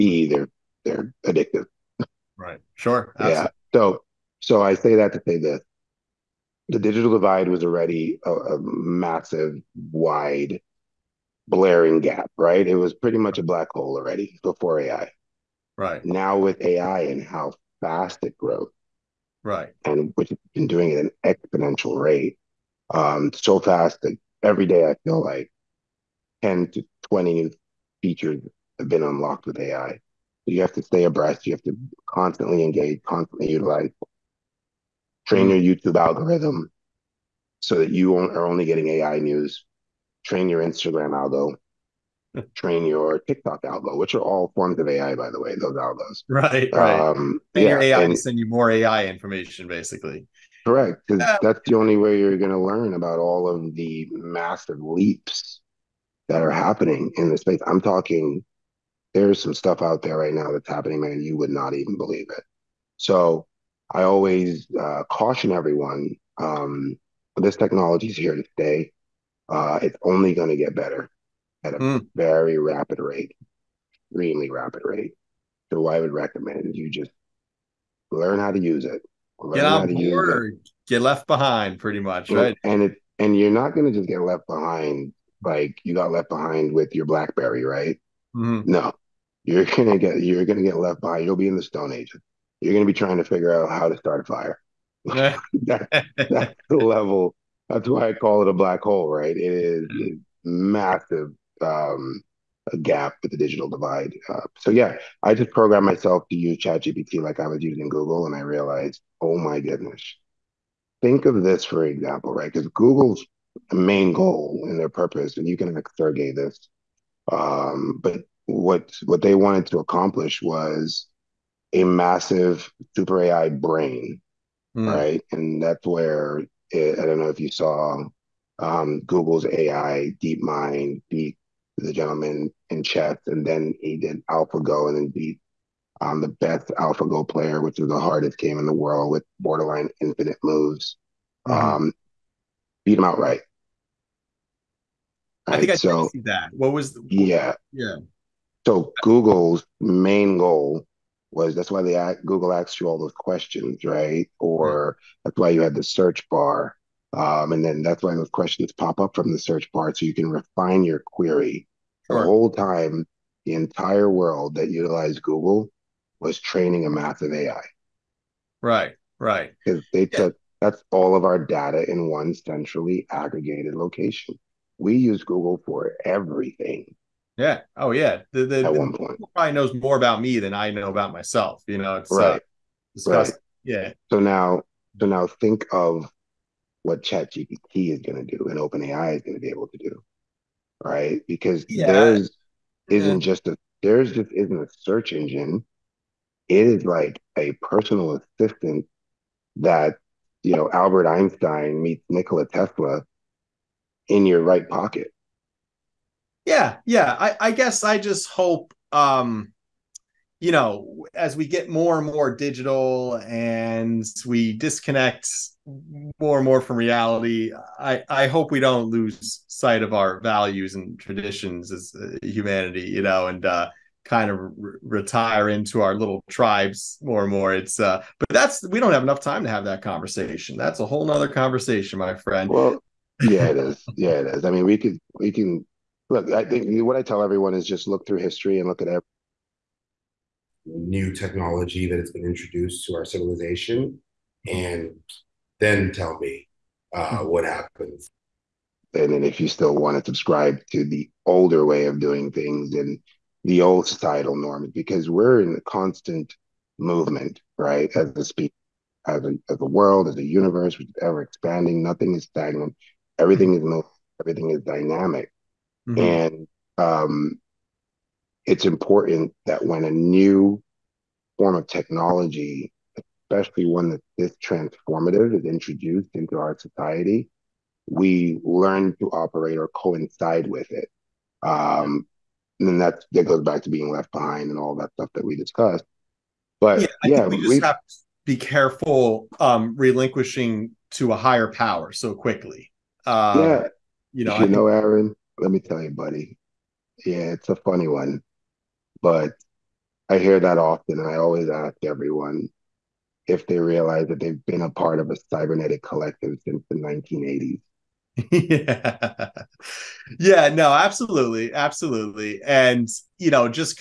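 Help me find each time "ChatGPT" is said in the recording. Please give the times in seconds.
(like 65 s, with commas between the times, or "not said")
106 s, 187 s.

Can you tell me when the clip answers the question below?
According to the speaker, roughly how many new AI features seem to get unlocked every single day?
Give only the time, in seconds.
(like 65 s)
26 s.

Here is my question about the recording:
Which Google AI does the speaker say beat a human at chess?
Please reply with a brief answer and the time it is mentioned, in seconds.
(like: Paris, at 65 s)
DeepMind, at 130 s.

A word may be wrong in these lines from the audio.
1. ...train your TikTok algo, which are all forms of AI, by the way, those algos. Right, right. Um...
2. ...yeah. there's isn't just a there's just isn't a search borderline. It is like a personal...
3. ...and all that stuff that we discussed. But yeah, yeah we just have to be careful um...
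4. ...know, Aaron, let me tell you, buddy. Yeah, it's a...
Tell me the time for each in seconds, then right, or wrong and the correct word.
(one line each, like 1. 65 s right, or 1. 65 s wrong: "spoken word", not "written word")
1. 42 s right
2. 191 s wrong: "engine", not "borderline"
3. 284 s right
4. 294 s right.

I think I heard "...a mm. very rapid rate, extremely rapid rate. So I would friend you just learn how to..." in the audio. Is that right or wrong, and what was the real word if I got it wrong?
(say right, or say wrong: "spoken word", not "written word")
wrong: "recommend", not "friend".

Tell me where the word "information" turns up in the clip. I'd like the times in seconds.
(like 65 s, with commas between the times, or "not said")
49 s.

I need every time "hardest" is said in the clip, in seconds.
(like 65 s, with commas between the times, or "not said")
137 s.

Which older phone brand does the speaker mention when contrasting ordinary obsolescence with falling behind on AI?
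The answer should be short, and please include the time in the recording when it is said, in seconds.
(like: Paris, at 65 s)
BlackBerry, at 87 s.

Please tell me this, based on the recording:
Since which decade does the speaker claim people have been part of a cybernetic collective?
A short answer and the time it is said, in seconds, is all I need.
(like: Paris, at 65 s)
1980s, at 306 s.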